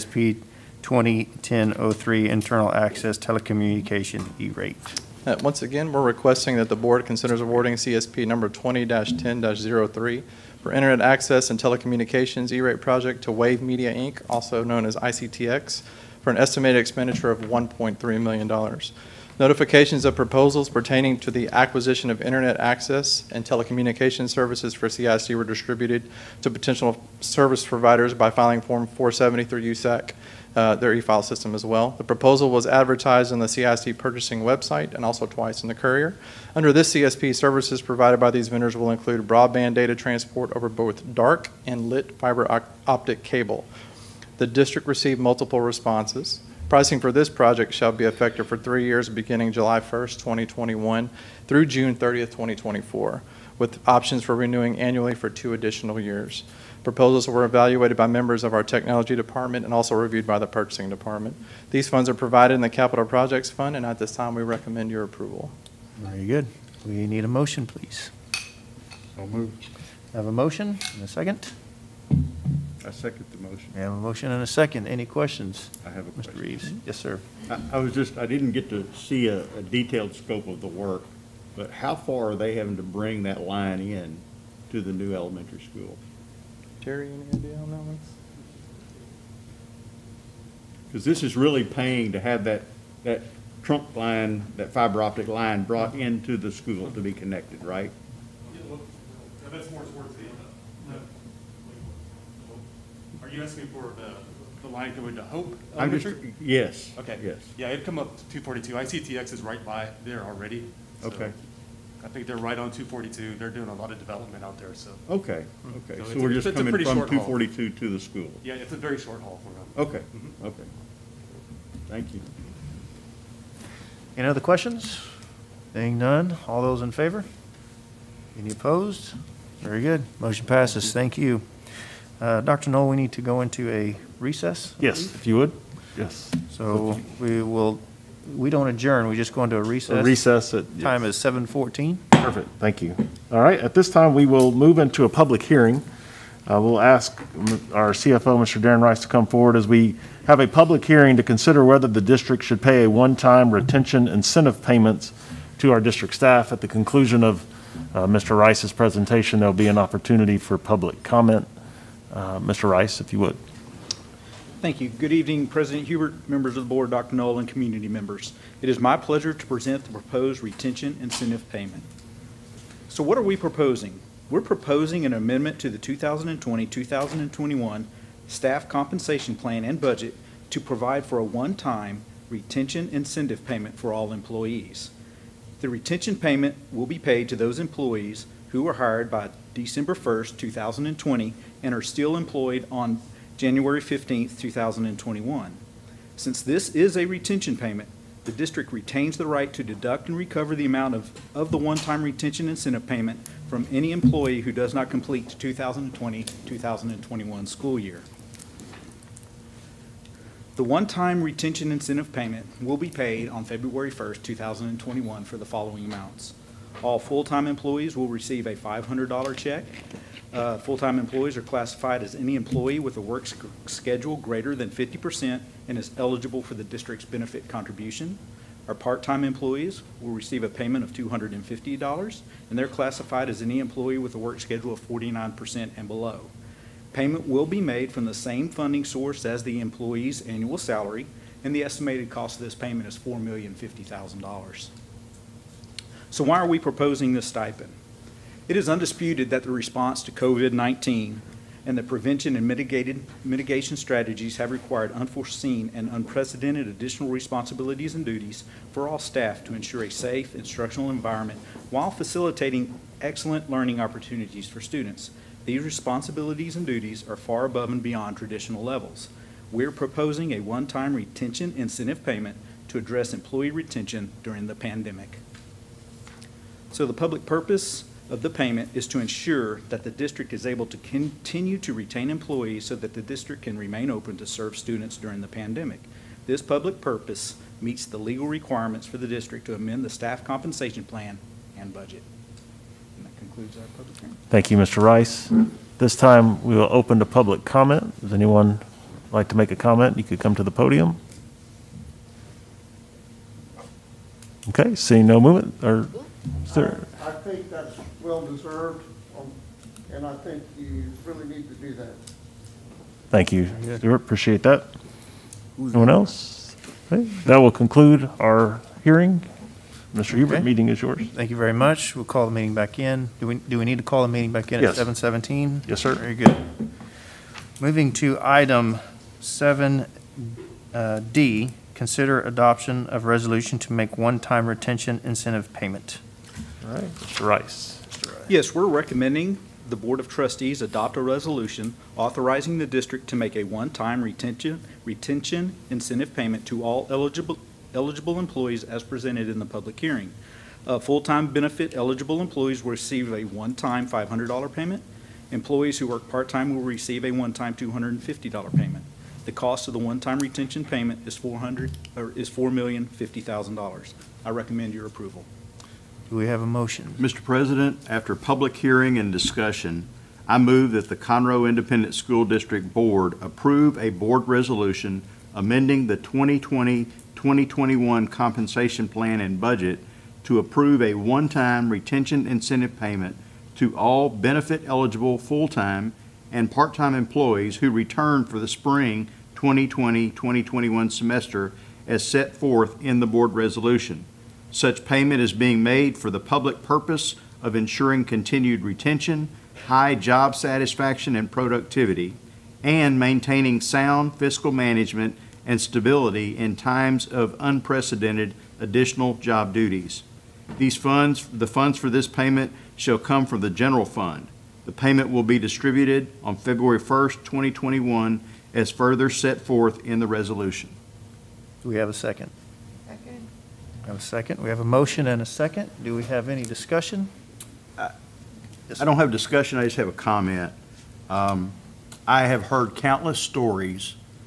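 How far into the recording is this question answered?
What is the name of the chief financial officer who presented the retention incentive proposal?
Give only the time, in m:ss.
2:28.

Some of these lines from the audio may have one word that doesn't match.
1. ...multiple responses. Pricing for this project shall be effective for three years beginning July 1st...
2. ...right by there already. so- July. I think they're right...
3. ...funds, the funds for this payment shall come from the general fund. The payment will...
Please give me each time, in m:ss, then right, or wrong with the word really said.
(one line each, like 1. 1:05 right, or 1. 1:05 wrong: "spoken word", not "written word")
1. 0:45 right
2. 1:49 wrong: "Okay", not "July"
3. 6:50 right.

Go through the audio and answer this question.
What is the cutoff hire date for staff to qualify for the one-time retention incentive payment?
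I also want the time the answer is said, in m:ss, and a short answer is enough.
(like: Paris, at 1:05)
December 1st, 2020, at 3:09.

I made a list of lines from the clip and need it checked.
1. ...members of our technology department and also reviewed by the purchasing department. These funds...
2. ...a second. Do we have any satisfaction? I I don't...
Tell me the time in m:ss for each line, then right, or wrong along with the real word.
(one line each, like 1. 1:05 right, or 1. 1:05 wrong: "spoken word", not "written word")
1. 0:58 right
2. 7:05 wrong: "discussion", not "satisfaction".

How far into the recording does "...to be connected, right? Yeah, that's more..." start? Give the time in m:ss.
1:36.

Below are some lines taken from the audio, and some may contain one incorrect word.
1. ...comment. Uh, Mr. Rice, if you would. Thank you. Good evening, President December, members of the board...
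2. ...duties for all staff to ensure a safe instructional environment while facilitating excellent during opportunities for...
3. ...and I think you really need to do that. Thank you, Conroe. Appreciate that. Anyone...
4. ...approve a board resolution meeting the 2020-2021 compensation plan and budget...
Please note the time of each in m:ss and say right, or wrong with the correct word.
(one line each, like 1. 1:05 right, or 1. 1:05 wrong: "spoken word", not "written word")
1. 2:41 wrong: "Hubert", not "December"
2. 4:18 wrong: "learning", not "during"
3. 5:09 wrong: "Stuart", not "Conroe"
4. 6:13 wrong: "amending", not "meeting".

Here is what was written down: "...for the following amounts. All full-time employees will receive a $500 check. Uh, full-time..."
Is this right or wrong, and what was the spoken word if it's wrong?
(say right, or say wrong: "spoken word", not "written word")
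right.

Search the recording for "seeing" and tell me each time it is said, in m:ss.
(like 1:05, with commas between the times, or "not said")
2:05, 5:04.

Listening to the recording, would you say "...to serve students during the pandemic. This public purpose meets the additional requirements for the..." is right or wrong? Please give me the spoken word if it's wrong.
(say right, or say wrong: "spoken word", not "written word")
wrong: "legal", not "additional".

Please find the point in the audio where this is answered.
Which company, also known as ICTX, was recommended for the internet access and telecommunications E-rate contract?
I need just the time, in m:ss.
0:13.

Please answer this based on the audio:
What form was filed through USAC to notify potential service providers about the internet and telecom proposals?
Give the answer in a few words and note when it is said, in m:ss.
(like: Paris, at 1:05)
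Form 473, at 0:28.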